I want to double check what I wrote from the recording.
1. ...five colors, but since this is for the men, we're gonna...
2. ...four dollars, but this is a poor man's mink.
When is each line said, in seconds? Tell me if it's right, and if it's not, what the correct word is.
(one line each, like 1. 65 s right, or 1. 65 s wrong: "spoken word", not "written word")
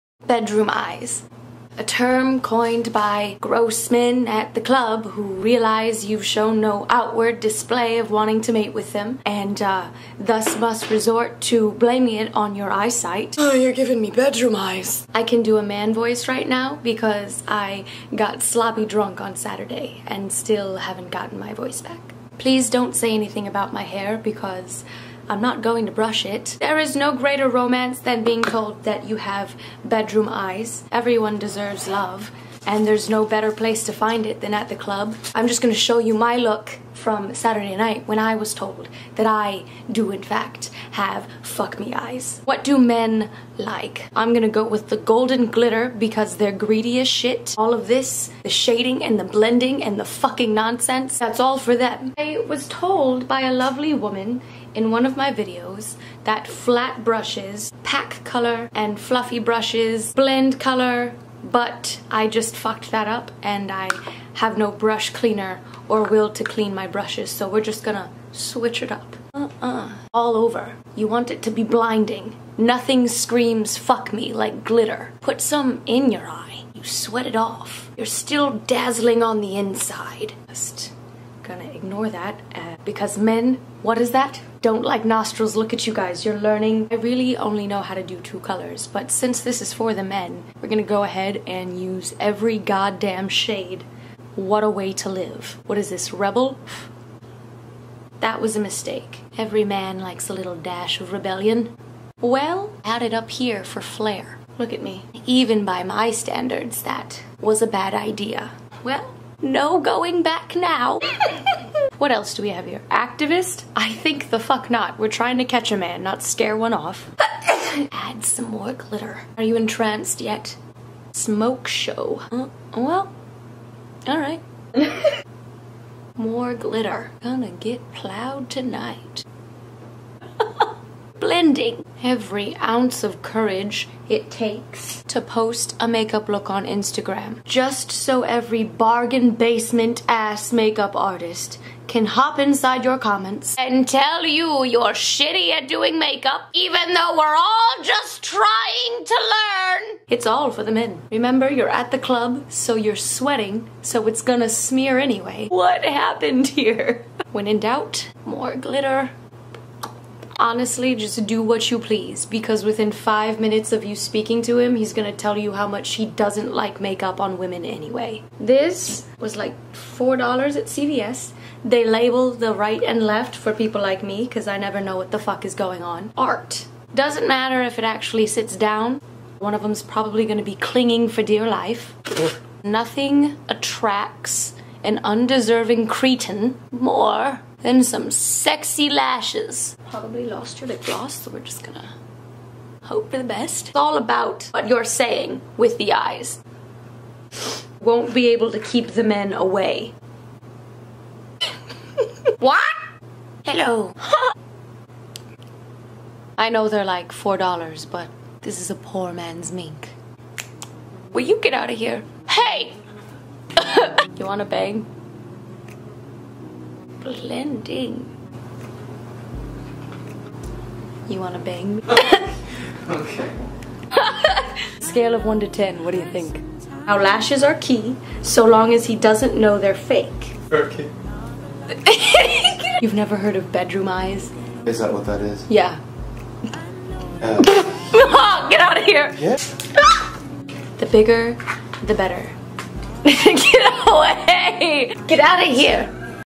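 1. 88 s wrong: "two", not "five"
2. 207 s right.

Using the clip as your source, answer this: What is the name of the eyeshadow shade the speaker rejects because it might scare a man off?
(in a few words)
Activist.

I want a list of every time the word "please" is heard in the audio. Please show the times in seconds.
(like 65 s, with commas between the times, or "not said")
22 s, 161 s.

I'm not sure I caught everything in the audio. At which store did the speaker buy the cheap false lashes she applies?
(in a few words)
CVS.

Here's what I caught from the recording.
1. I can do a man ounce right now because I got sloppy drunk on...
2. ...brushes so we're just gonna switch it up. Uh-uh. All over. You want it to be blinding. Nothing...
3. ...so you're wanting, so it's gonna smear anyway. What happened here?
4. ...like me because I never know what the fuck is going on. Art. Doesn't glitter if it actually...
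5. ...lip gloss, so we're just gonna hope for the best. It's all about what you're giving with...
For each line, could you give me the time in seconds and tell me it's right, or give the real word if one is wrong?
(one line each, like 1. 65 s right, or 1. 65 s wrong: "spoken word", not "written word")
1. 15 s wrong: "voice", not "ounce"
2. 66 s right
3. 152 s wrong: "sweating", not "wanting"
4. 173 s wrong: "matter", not "glitter"
5. 190 s wrong: "saying", not "giving".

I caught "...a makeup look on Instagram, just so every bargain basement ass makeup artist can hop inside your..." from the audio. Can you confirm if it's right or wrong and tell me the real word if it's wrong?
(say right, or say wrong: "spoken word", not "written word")
right.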